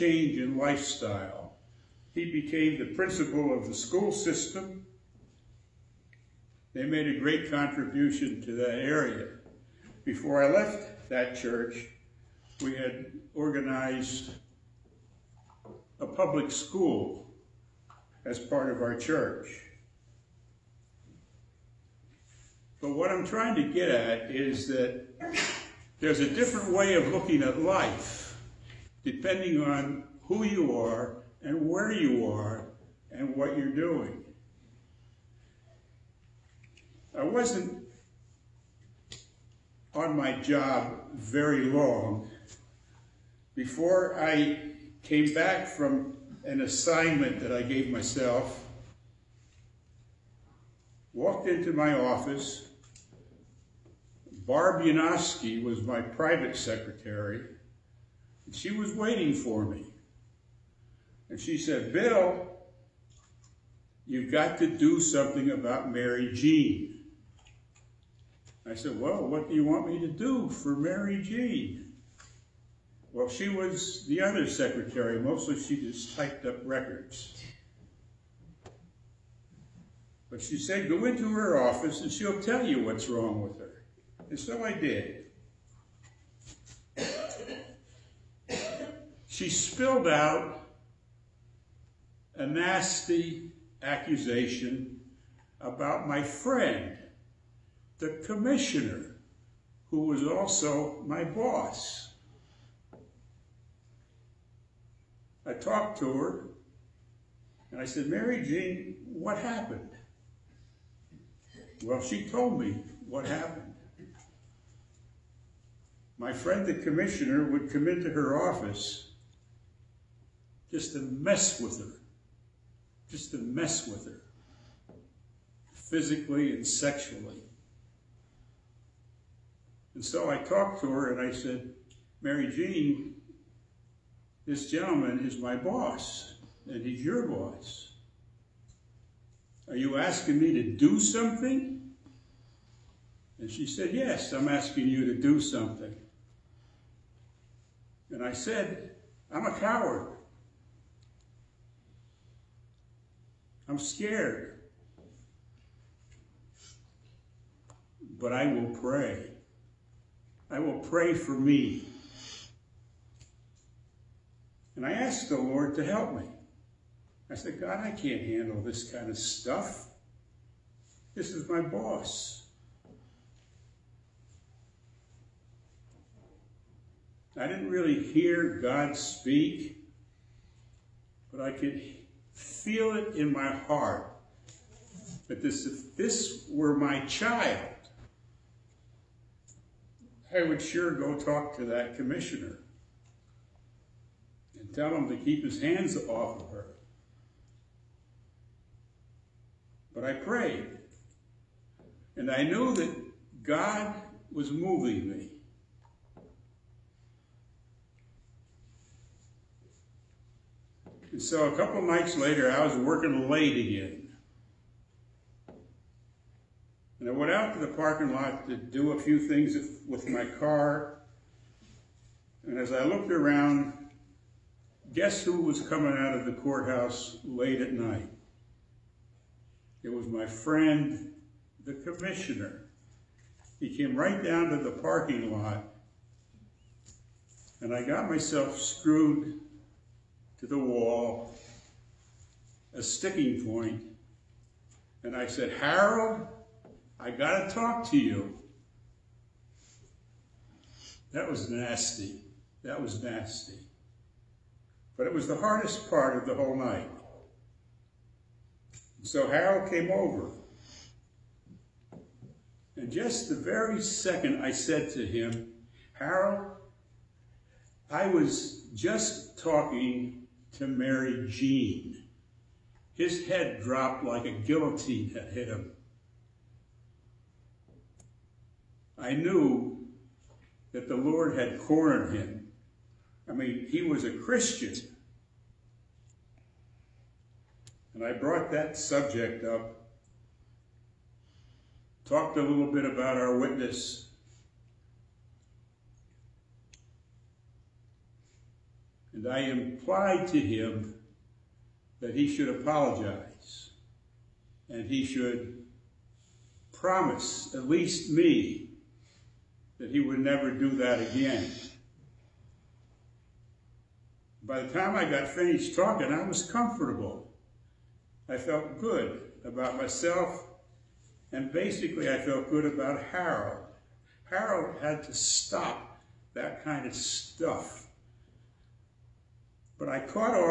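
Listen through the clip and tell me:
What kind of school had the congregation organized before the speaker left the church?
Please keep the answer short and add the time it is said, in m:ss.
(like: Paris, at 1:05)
public school, at 0:16.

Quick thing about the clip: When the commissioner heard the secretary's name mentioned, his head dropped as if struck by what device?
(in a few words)
guillotine.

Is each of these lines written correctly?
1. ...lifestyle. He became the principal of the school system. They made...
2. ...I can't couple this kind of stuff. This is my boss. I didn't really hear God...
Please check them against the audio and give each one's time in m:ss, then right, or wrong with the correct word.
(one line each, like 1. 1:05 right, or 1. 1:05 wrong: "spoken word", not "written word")
1. 0:00 right
2. 2:47 wrong: "handle", not "couple".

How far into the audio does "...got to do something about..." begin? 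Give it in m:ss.
1:04.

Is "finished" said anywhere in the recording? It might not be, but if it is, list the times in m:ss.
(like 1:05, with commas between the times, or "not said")
5:15.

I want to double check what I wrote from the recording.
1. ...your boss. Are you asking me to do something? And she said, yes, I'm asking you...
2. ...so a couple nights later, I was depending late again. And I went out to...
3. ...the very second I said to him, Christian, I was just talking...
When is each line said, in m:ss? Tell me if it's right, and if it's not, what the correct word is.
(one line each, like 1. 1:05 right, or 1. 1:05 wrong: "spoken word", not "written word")
1. 2:17 right
2. 3:31 wrong: "working", not "depending"
3. 4:23 wrong: "Harold", not "Christian".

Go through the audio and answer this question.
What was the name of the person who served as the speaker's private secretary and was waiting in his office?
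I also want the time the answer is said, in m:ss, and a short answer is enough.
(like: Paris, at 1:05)
Barb Yanofsky, at 0:54.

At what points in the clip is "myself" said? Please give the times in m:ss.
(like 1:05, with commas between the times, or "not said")
0:47, 3:58, 5:19.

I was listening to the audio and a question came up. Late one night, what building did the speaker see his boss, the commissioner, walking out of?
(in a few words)
courthouse.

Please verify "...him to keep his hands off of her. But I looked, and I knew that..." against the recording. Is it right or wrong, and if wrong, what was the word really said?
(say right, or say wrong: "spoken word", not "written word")
wrong: "prayed", not "looked".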